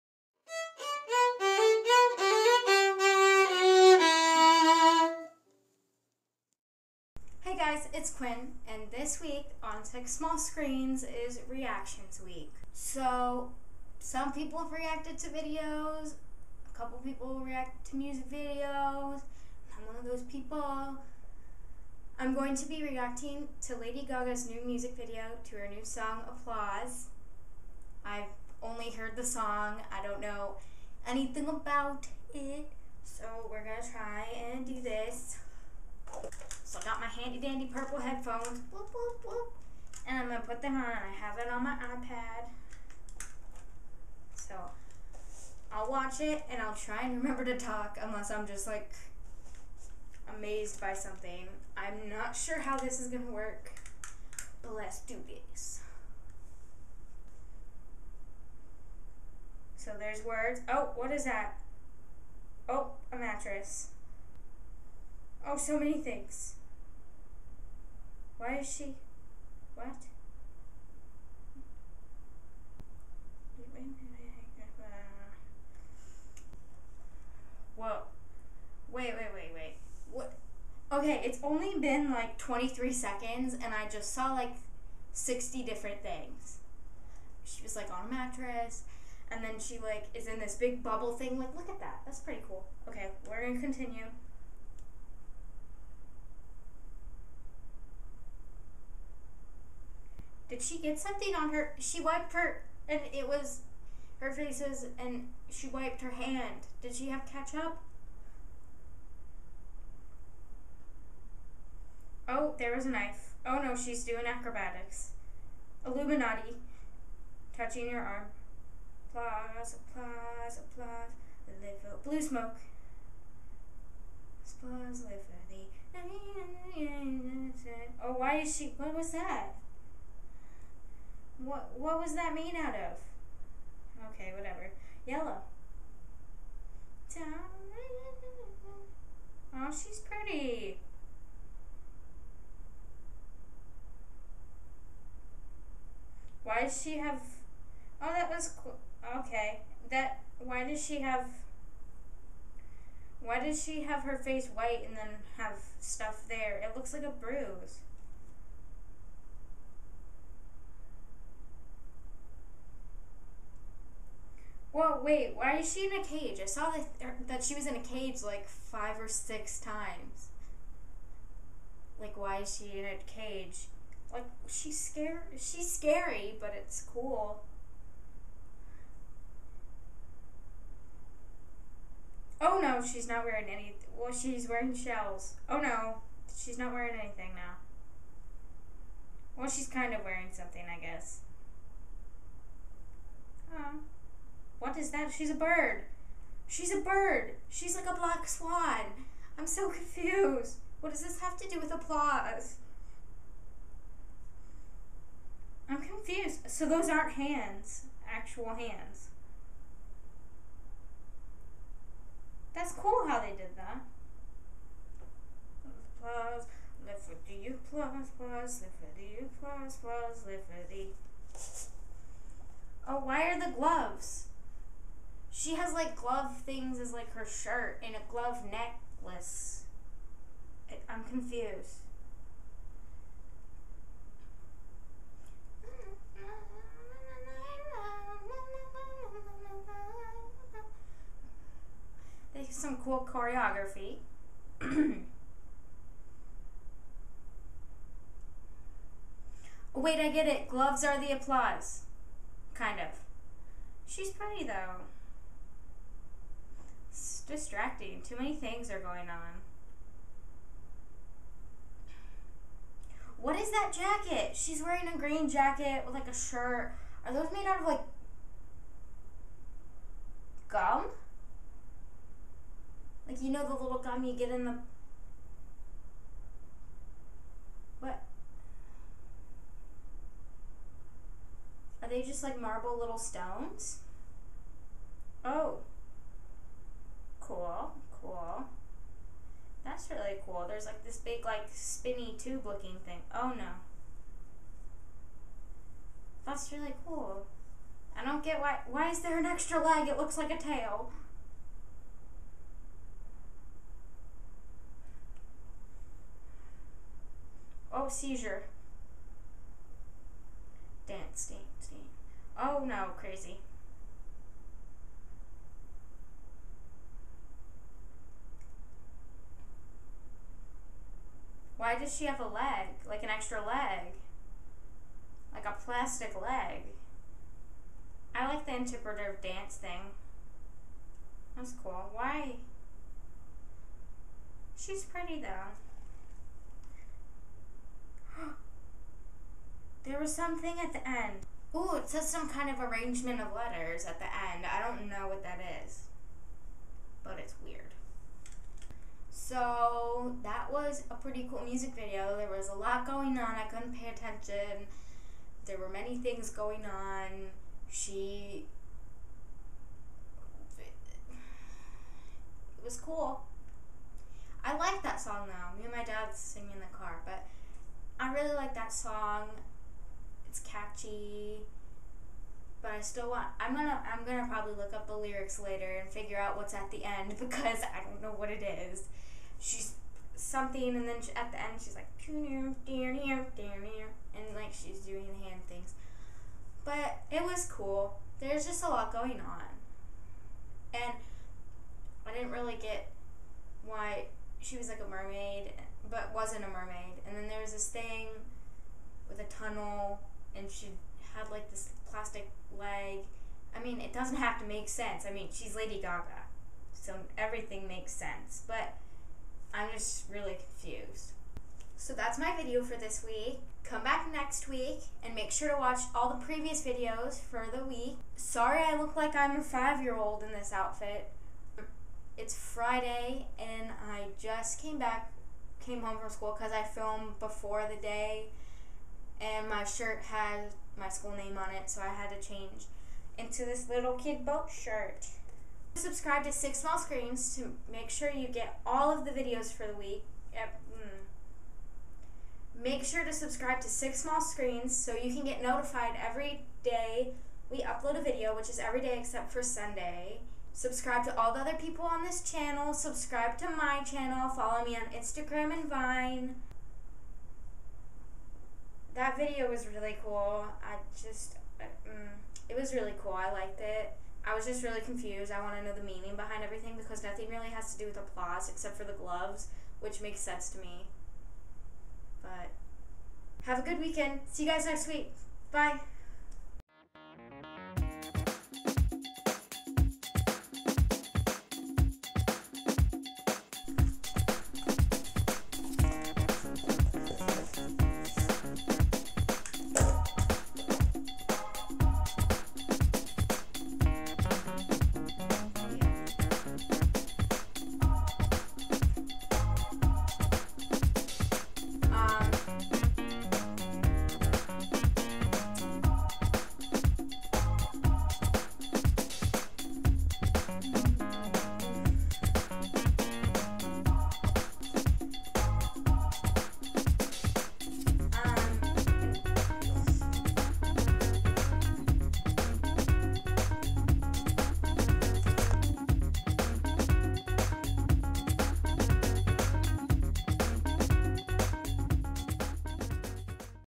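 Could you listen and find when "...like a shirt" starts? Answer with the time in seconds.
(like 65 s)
265 s.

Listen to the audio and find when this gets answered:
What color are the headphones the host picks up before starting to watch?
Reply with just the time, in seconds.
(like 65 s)
37 s.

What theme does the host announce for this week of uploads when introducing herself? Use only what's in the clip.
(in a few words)
Reactions Week.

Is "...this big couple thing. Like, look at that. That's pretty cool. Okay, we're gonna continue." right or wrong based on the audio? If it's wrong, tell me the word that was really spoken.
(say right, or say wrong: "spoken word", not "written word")
wrong: "bubble", not "couple".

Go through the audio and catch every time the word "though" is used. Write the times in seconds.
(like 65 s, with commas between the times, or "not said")
254 s, 335 s, 365 s.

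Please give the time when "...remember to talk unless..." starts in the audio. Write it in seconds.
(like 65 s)
47 s.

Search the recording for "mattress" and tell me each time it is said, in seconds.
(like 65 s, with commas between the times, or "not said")
63 s, 88 s.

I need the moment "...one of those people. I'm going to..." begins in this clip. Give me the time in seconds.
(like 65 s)
19 s.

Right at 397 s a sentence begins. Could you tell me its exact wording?
And then there was this thing with a tunnel, and she had like this plastic leg.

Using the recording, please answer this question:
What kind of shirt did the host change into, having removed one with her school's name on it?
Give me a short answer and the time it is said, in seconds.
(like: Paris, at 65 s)
Boat shirt, at 434 s.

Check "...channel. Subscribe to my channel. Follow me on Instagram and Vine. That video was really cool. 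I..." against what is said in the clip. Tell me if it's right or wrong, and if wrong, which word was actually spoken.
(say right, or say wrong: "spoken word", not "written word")
right.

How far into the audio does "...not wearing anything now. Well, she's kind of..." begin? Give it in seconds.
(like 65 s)
186 s.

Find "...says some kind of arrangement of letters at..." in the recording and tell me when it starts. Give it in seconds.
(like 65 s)
341 s.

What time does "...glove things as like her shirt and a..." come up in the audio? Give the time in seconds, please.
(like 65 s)
225 s.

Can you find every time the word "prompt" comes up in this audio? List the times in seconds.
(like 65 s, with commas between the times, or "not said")
not said.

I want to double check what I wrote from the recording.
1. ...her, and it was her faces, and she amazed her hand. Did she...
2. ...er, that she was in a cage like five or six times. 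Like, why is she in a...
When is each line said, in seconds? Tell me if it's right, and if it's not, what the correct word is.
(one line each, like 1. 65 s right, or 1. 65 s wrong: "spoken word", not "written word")
1. 102 s wrong: "wiped", not "amazed"
2. 167 s right.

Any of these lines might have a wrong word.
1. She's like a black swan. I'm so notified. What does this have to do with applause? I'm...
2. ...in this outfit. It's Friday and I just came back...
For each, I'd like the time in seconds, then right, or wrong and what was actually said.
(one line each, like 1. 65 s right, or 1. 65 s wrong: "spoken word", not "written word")
1. 197 s wrong: "confused", not "notified"
2. 420 s right.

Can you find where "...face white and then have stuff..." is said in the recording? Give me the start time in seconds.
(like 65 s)
154 s.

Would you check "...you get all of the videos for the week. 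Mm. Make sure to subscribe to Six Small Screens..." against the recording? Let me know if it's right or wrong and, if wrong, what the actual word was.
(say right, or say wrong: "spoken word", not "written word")
right.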